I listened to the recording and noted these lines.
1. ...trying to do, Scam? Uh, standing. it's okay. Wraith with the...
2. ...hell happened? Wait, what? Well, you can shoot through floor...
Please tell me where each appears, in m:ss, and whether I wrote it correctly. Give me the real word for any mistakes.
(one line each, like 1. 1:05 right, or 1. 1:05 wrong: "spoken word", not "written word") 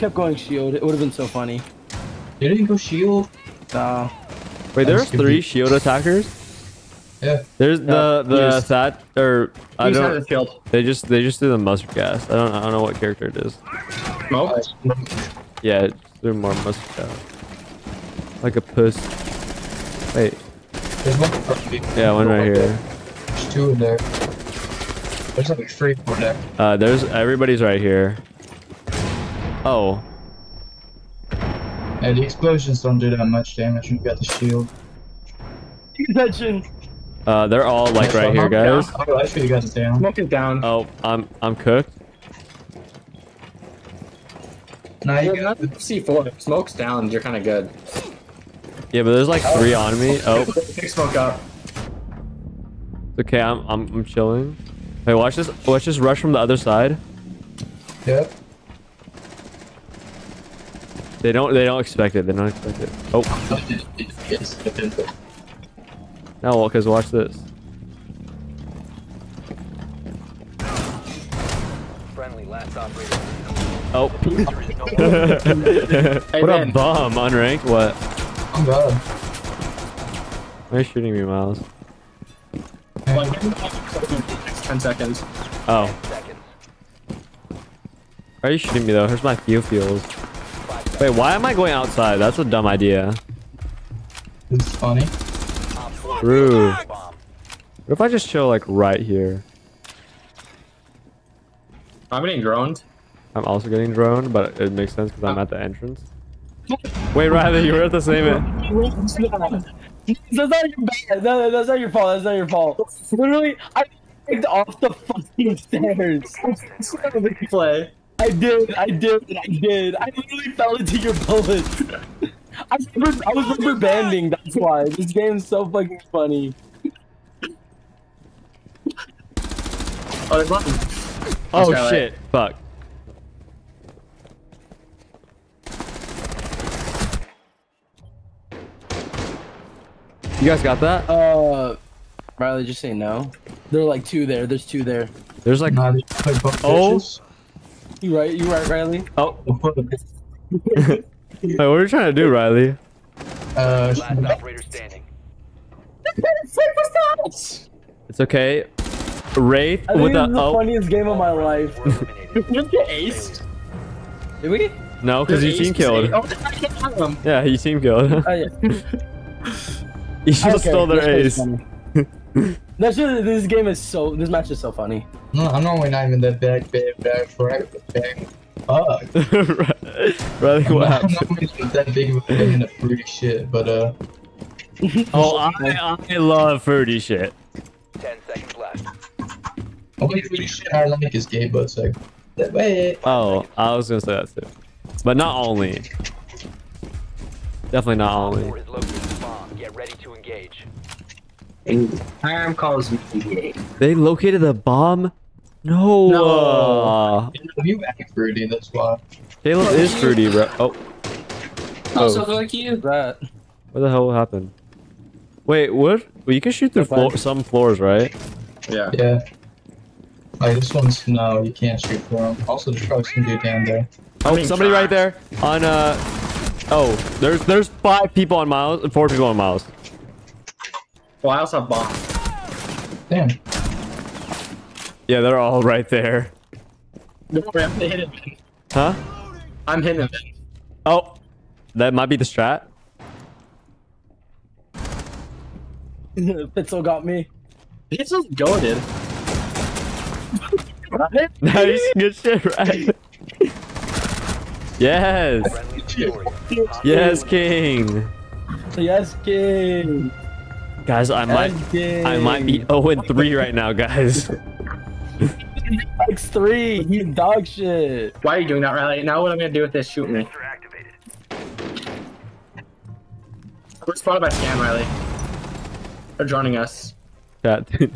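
1. 2:31 wrong: "Riley", not "Scam"
2. 3:33 right.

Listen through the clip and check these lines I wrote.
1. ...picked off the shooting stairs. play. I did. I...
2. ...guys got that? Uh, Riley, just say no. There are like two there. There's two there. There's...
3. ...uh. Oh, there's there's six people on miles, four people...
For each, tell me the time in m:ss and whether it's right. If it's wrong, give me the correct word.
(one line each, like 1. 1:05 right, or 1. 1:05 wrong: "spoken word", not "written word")
1. 1:54 wrong: "fucking", not "shooting"
2. 2:20 right
3. 3:45 wrong: "five", not "six".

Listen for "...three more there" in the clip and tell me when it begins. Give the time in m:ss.
0:25.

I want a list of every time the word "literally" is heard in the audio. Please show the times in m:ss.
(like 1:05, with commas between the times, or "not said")
1:53, 2:00.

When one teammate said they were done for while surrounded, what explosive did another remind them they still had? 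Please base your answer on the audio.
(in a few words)
C4.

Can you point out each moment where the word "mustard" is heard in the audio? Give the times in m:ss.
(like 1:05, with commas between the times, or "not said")
0:11, 0:16.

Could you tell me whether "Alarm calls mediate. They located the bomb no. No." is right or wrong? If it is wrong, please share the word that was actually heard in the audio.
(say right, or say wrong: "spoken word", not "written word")
right.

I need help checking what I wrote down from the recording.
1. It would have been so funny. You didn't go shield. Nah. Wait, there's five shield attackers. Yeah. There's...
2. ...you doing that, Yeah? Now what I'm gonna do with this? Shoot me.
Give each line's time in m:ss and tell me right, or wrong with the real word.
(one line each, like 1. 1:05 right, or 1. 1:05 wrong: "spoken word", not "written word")
1. 0:00 wrong: "three", not "five"
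2. 4:28 wrong: "Riley", not "Yeah".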